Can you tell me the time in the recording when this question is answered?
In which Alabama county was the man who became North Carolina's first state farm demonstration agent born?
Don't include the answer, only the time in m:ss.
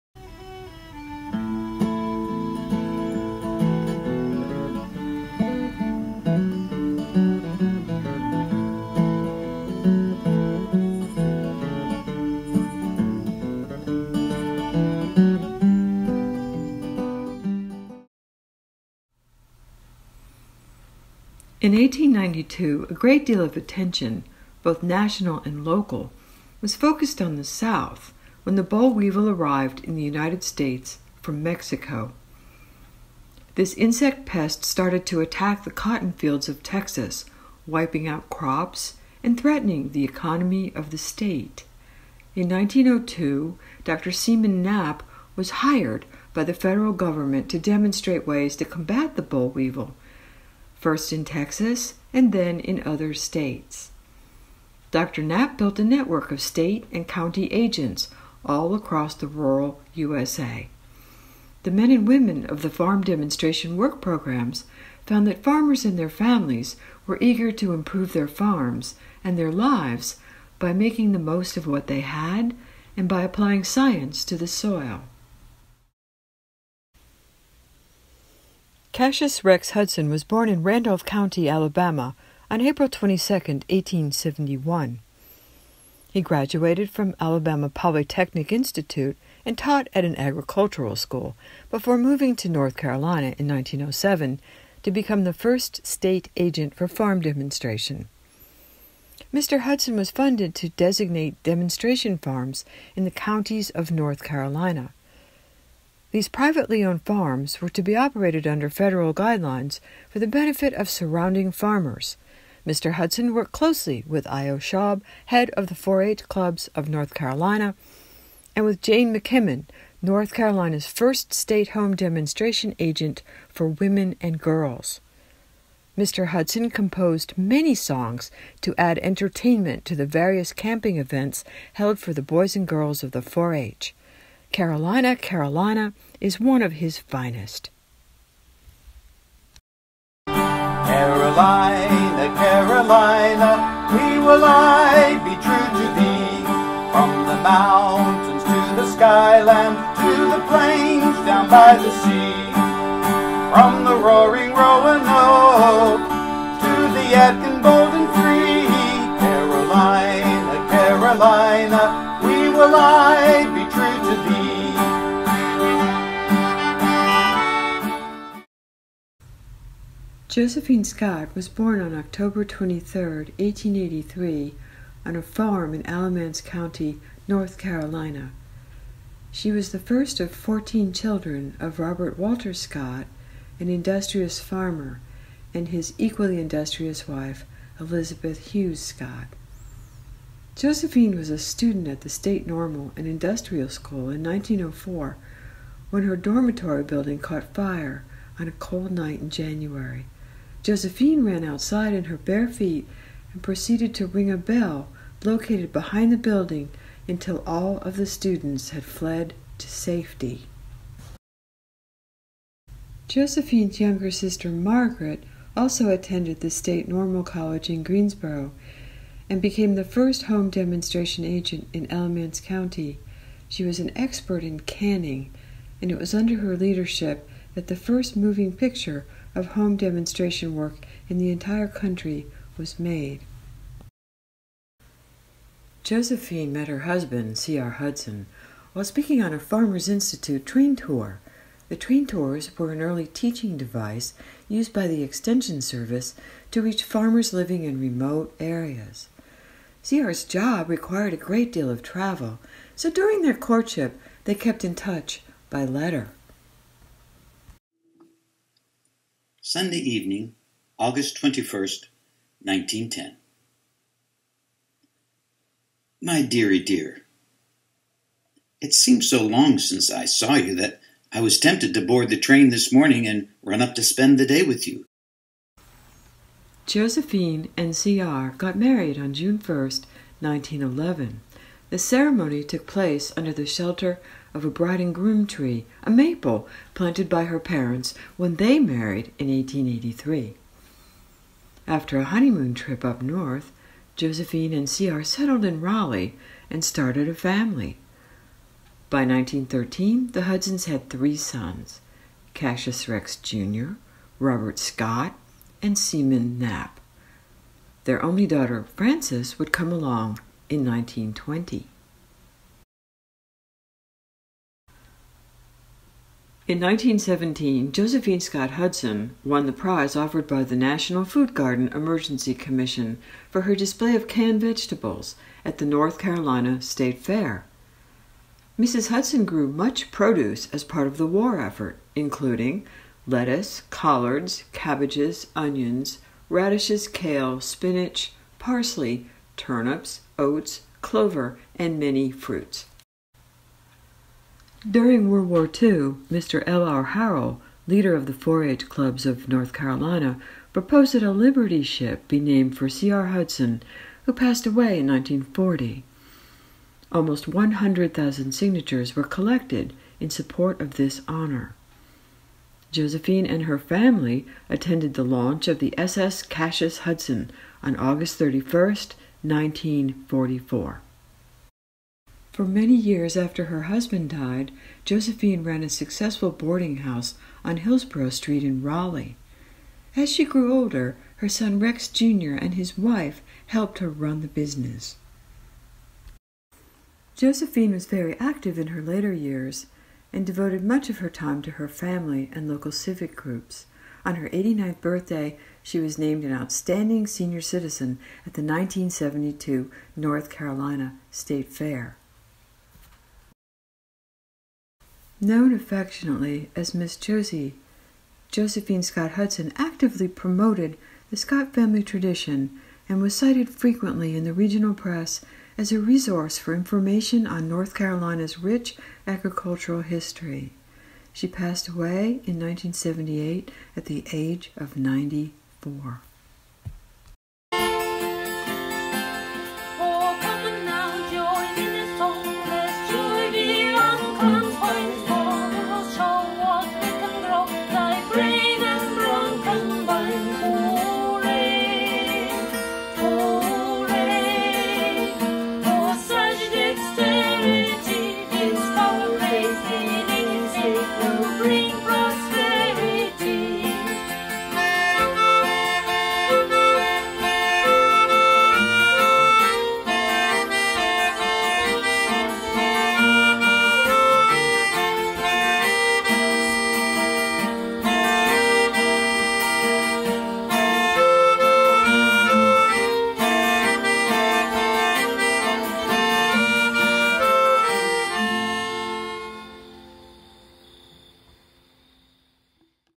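1:20.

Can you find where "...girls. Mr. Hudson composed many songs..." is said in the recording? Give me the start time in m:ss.
2:04.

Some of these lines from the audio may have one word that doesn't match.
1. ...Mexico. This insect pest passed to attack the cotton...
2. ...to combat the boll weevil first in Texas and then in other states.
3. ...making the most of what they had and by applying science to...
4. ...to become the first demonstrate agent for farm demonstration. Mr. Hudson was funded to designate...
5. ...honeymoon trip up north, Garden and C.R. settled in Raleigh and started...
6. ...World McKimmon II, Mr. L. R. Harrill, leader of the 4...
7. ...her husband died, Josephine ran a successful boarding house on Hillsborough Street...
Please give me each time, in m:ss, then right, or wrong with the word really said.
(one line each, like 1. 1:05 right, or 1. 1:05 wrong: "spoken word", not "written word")
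1. 0:31 wrong: "started", not "passed"
2. 0:48 right
3. 1:10 right
4. 1:34 wrong: "state", not "demonstrate"
5. 4:52 wrong: "Josephine", not "Garden"
6. 5:45 wrong: "War", not "McKimmon"
7. 6:13 right.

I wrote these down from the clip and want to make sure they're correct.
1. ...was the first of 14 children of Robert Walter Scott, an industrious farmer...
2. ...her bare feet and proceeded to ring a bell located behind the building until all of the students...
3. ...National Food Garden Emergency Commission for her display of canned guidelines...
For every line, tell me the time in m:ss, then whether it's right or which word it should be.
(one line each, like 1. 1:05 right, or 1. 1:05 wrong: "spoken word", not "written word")
1. 2:59 right
2. 3:22 right
3. 5:20 wrong: "vegetables", not "guidelines".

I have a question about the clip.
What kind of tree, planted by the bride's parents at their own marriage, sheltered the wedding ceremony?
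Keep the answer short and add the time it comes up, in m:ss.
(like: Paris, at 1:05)
maple, at 4:45.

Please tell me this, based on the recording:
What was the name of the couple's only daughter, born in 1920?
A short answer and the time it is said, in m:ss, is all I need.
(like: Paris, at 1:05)
Frances, at 5:08.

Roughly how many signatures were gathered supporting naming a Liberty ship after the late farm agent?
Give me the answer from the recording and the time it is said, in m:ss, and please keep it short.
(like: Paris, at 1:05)
100,000, at 5:57.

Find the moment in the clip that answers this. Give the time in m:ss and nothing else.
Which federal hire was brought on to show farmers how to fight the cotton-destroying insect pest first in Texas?
0:43.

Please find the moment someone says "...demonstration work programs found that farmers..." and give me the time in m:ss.
1:03.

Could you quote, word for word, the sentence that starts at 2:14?
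Carolina, Carolina is one of his finest.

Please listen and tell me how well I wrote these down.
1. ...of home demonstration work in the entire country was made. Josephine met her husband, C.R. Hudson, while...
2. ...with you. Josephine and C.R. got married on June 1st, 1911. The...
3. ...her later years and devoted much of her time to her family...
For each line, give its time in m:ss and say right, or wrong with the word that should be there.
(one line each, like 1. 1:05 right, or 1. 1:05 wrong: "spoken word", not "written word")
1. 3:49 right
2. 4:34 right
3. 6:28 right.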